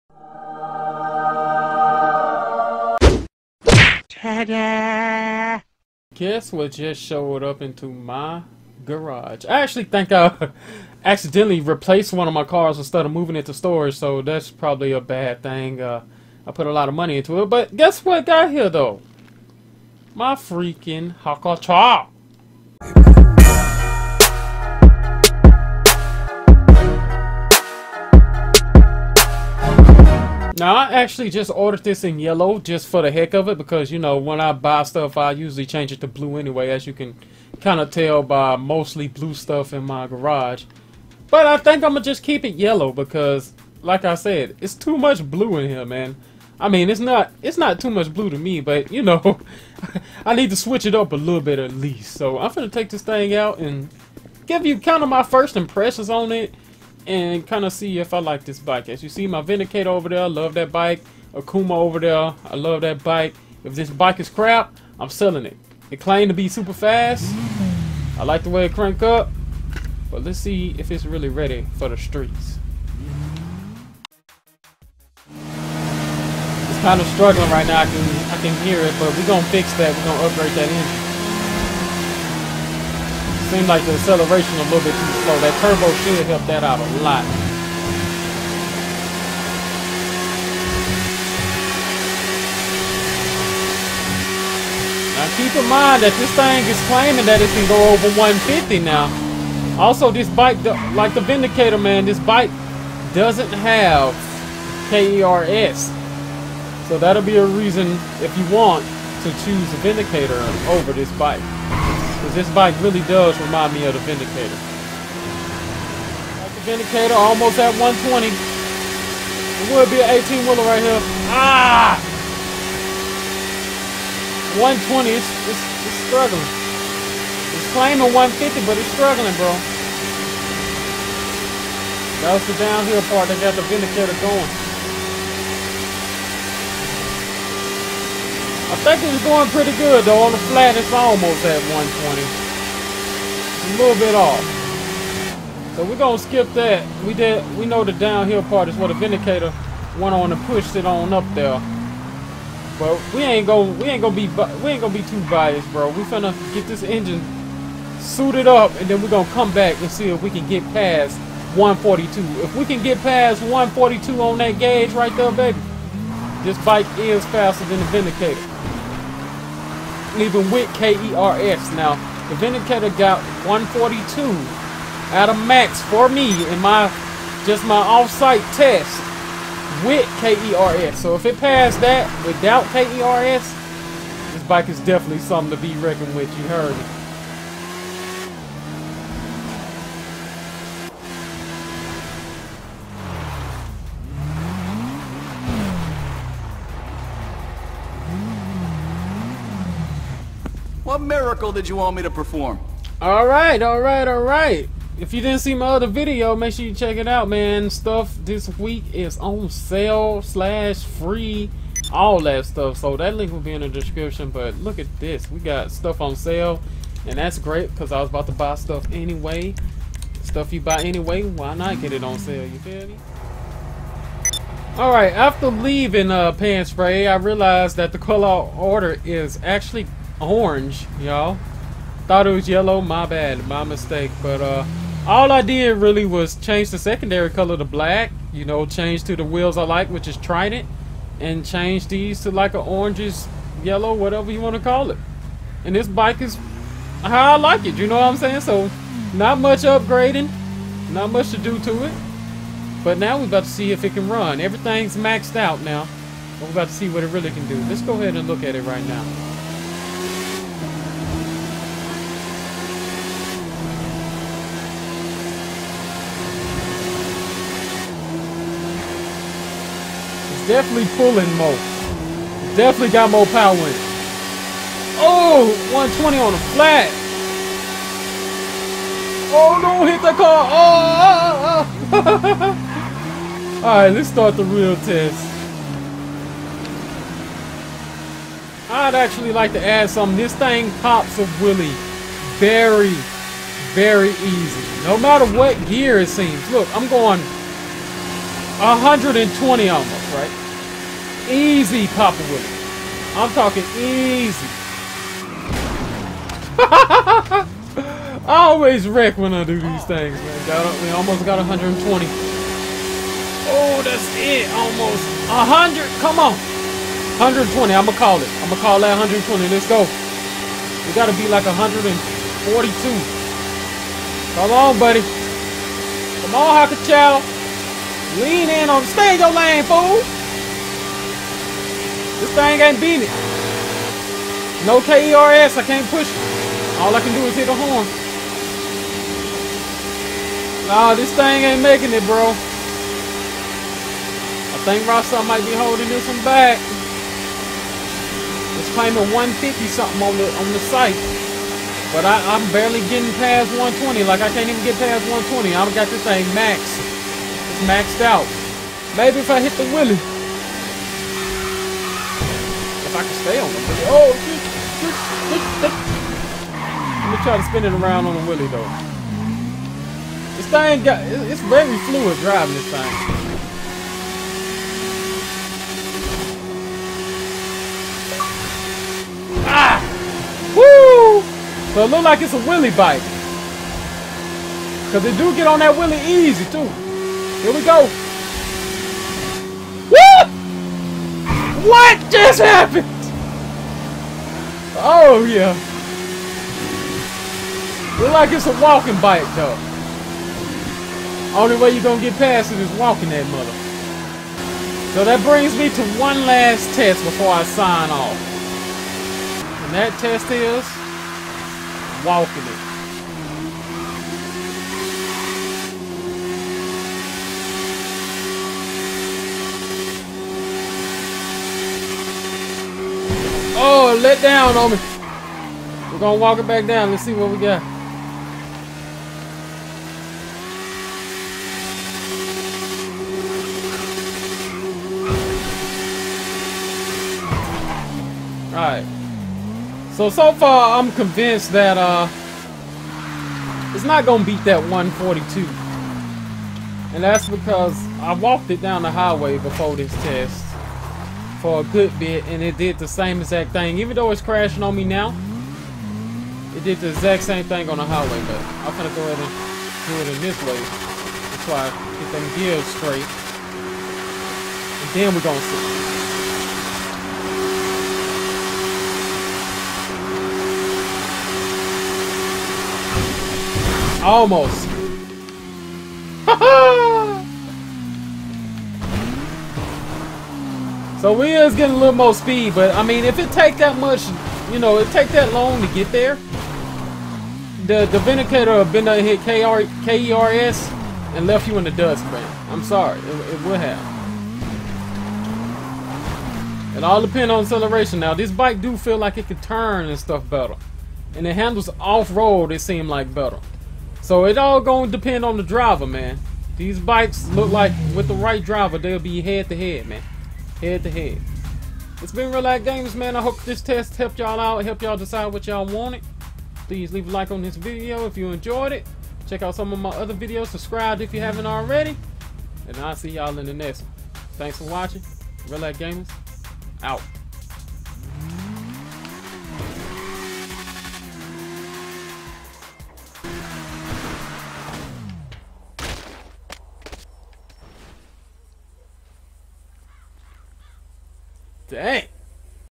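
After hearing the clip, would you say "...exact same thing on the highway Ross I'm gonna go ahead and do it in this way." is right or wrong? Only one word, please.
wrong.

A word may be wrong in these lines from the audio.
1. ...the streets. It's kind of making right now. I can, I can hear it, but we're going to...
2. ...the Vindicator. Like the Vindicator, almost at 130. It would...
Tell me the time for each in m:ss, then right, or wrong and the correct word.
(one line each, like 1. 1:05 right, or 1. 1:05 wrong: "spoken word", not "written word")
1. 1:11 wrong: "struggling", not "making"
2. 1:53 wrong: "120", not "130".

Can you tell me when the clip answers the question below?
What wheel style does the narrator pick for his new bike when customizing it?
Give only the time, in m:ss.
4:00.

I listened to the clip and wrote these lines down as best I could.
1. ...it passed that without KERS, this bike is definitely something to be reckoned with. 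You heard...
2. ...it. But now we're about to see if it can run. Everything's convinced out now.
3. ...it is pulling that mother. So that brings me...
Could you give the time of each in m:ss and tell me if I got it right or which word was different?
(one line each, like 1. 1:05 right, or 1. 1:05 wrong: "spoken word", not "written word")
1. 3:01 right
2. 4:11 wrong: "maxed", not "convinced"
3. 6:42 wrong: "walking", not "pulling".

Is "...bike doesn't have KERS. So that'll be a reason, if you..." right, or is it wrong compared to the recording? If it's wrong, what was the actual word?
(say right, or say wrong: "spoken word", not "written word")
right.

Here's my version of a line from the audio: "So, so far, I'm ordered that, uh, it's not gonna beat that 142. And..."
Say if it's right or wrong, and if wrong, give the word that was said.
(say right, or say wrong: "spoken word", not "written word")
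wrong: "convinced", not "ordered".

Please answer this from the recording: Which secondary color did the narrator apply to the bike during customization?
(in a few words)
black.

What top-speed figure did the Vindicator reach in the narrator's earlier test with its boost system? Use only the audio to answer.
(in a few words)
142.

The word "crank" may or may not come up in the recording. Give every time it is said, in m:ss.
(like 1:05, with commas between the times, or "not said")
1:08.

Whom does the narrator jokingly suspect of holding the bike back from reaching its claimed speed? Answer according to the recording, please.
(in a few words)
Ross.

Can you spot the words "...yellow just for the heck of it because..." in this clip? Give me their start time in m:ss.
0:32.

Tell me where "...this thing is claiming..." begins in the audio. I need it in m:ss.
1:36.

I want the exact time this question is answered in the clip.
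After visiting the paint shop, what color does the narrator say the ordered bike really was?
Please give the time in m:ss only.
3:49.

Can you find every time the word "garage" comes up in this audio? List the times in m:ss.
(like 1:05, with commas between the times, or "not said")
0:08, 0:40.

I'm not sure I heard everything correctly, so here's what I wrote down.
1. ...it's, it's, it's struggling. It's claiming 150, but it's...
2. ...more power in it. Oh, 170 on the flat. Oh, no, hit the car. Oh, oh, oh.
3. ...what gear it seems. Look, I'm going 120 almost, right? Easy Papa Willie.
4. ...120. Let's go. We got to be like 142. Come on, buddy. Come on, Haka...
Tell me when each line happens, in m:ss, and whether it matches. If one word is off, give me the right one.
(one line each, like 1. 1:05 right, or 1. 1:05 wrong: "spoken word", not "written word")
1. 2:05 right
2. 4:33 wrong: "120", not "170"
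3. 4:55 right
4. 5:18 right.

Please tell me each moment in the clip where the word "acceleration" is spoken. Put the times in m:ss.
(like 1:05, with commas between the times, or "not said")
1:23, 8:17.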